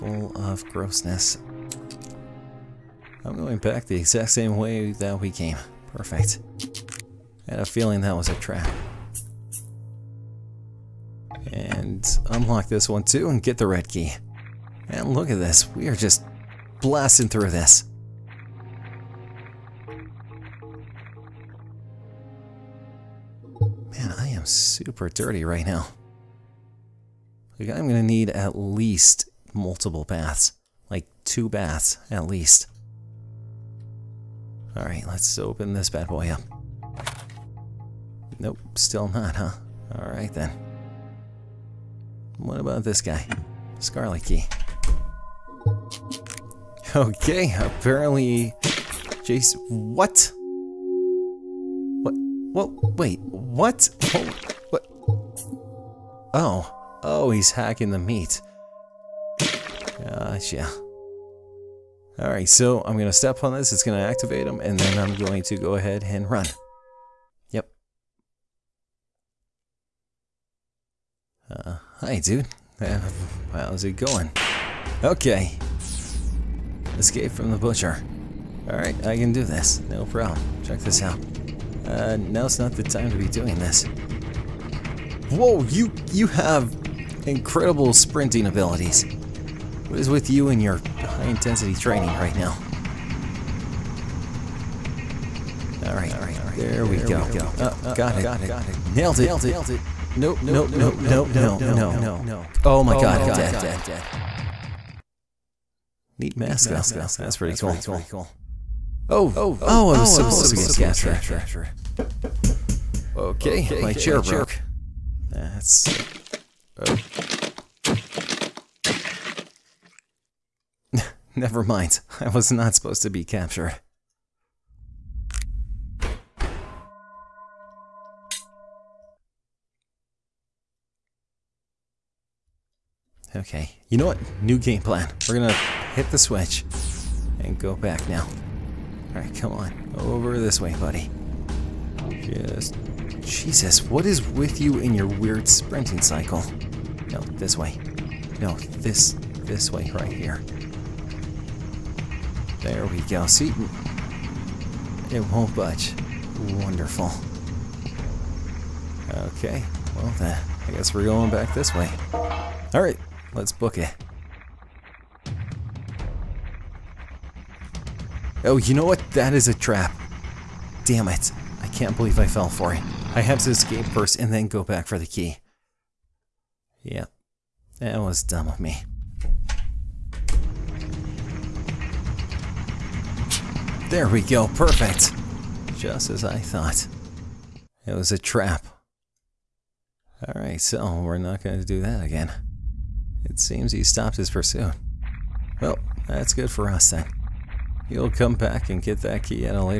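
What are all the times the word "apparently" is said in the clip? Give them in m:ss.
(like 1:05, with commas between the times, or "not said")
0:47.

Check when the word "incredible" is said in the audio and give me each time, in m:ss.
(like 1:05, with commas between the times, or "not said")
1:27.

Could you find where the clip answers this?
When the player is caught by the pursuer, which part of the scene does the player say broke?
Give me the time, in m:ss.
1:53.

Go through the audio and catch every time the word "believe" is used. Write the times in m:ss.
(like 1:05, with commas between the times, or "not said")
2:51.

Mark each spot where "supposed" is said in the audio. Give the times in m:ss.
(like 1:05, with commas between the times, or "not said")
1:50, 2:02.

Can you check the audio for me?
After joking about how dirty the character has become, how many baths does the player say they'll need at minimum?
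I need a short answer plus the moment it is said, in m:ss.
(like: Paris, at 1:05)
2, at 0:31.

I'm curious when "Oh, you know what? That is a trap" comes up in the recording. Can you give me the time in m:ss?
2:48.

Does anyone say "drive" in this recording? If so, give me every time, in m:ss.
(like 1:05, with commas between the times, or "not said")
not said.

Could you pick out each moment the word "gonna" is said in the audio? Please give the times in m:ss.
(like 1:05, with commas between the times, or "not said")
0:27, 2:15.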